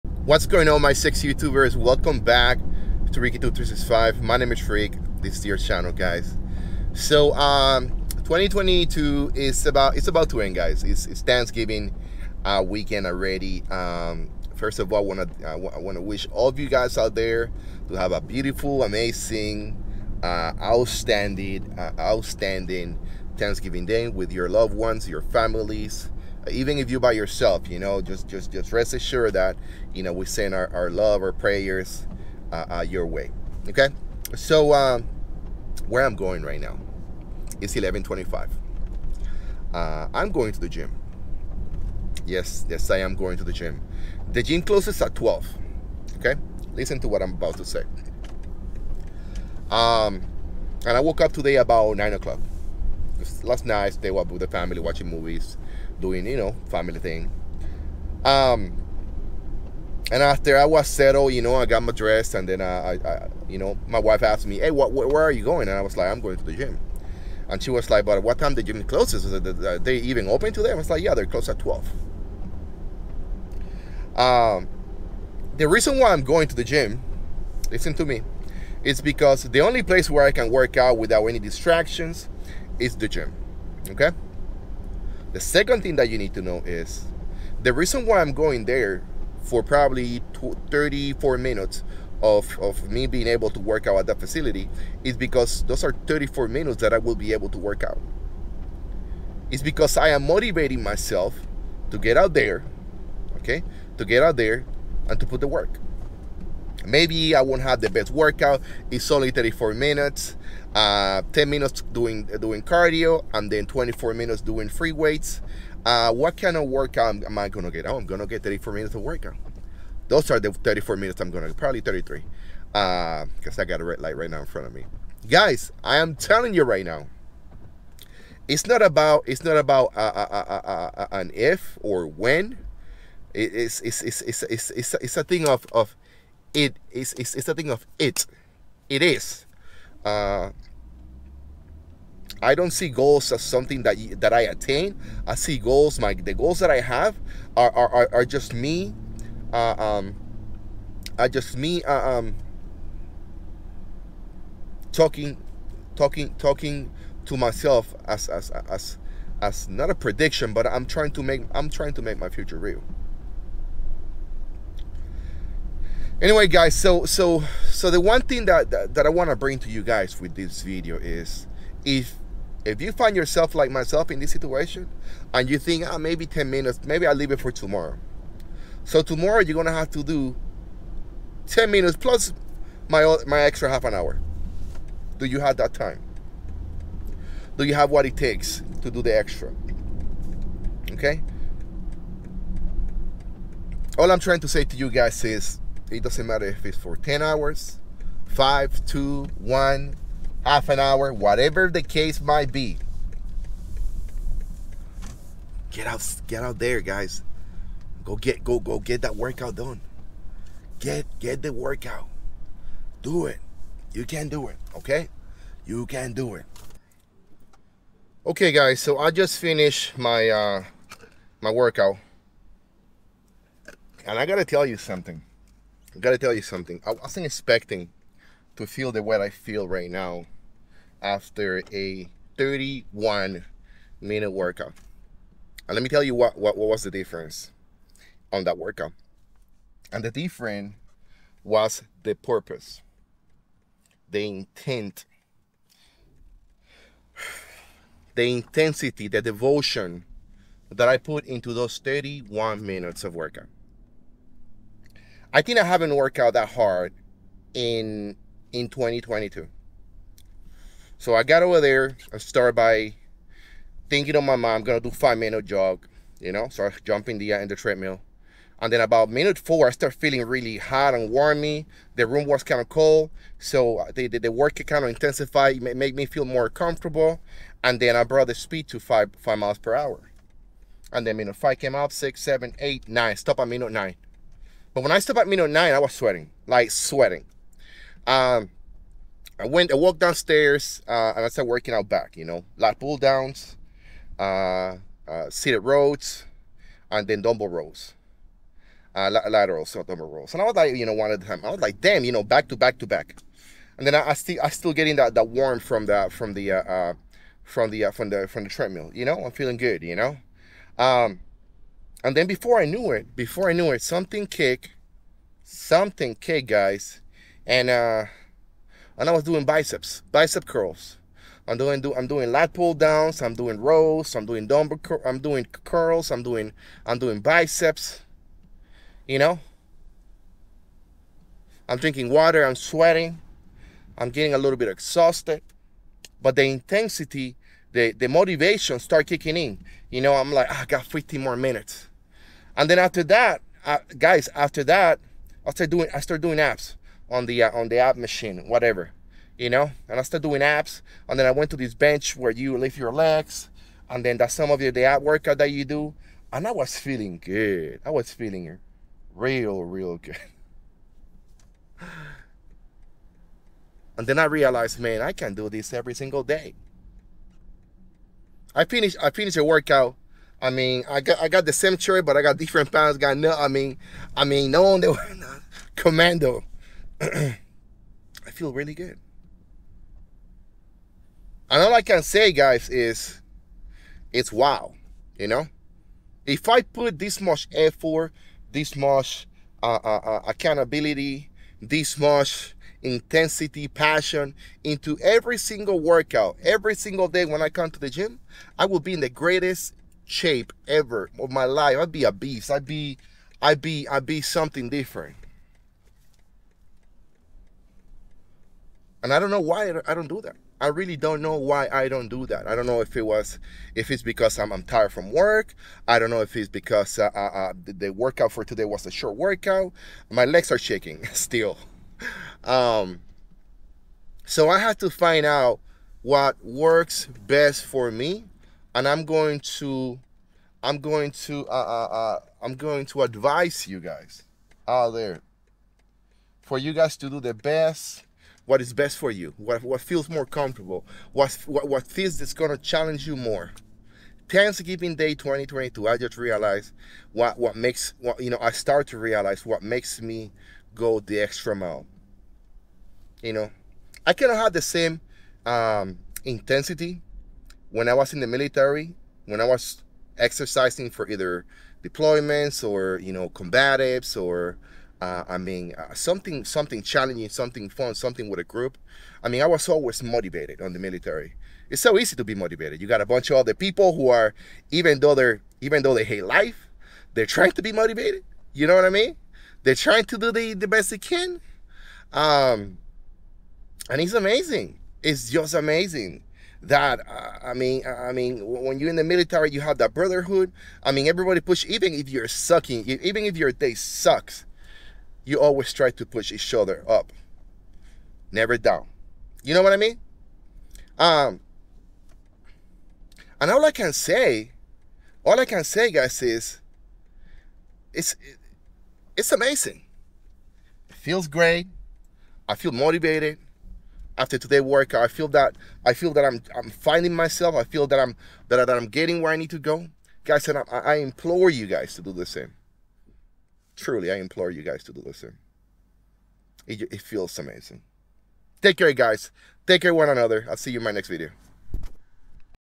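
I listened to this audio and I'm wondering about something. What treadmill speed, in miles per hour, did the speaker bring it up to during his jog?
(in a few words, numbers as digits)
5.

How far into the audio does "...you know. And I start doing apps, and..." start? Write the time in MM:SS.
05:49.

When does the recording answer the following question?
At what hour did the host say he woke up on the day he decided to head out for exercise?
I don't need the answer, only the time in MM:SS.
00:51.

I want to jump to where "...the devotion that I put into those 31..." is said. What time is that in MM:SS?
04:09.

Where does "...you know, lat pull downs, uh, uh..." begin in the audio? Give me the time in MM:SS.
04:52.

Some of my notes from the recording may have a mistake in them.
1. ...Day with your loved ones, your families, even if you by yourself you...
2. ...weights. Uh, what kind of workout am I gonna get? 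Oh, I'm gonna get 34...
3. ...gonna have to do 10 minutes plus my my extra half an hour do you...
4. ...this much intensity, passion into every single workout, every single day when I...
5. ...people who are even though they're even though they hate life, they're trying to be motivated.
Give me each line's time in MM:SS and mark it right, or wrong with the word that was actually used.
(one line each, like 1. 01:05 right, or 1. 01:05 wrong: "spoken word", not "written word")
1. 00:23 right
2. 01:54 right
3. 02:59 right
4. 06:31 right
5. 07:53 right.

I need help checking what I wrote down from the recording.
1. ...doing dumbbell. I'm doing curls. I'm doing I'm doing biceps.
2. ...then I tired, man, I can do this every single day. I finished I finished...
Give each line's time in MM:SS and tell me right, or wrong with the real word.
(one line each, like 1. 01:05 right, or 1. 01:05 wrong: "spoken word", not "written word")
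1. 05:24 right
2. 06:04 wrong: "realized", not "tired".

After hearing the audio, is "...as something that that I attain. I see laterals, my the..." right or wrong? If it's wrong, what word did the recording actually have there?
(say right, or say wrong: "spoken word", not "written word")
wrong: "goals", not "laterals".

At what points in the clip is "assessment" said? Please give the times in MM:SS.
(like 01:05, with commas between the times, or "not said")
not said.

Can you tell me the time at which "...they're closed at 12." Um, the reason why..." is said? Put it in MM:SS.
01:11.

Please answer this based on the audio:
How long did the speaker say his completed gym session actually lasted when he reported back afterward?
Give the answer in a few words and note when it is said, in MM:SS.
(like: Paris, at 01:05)
31 minutes, at 03:52.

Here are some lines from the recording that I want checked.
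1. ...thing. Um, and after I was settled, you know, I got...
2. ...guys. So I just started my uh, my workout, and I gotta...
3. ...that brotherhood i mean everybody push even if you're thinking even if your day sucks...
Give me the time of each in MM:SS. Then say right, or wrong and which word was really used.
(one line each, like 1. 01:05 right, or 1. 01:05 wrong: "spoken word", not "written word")
1. 00:56 right
2. 03:38 wrong: "finished", not "started"
3. 08:09 wrong: "sucking", not "thinking".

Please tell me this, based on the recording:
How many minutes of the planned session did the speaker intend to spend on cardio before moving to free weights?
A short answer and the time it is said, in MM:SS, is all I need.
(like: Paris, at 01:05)
10 minutes, at 01:51.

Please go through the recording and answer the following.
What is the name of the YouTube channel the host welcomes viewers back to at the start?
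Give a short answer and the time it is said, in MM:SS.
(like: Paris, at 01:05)
RickyTube365, at 00:03.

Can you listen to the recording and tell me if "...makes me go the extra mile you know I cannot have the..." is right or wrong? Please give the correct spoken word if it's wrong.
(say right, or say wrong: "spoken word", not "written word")
right.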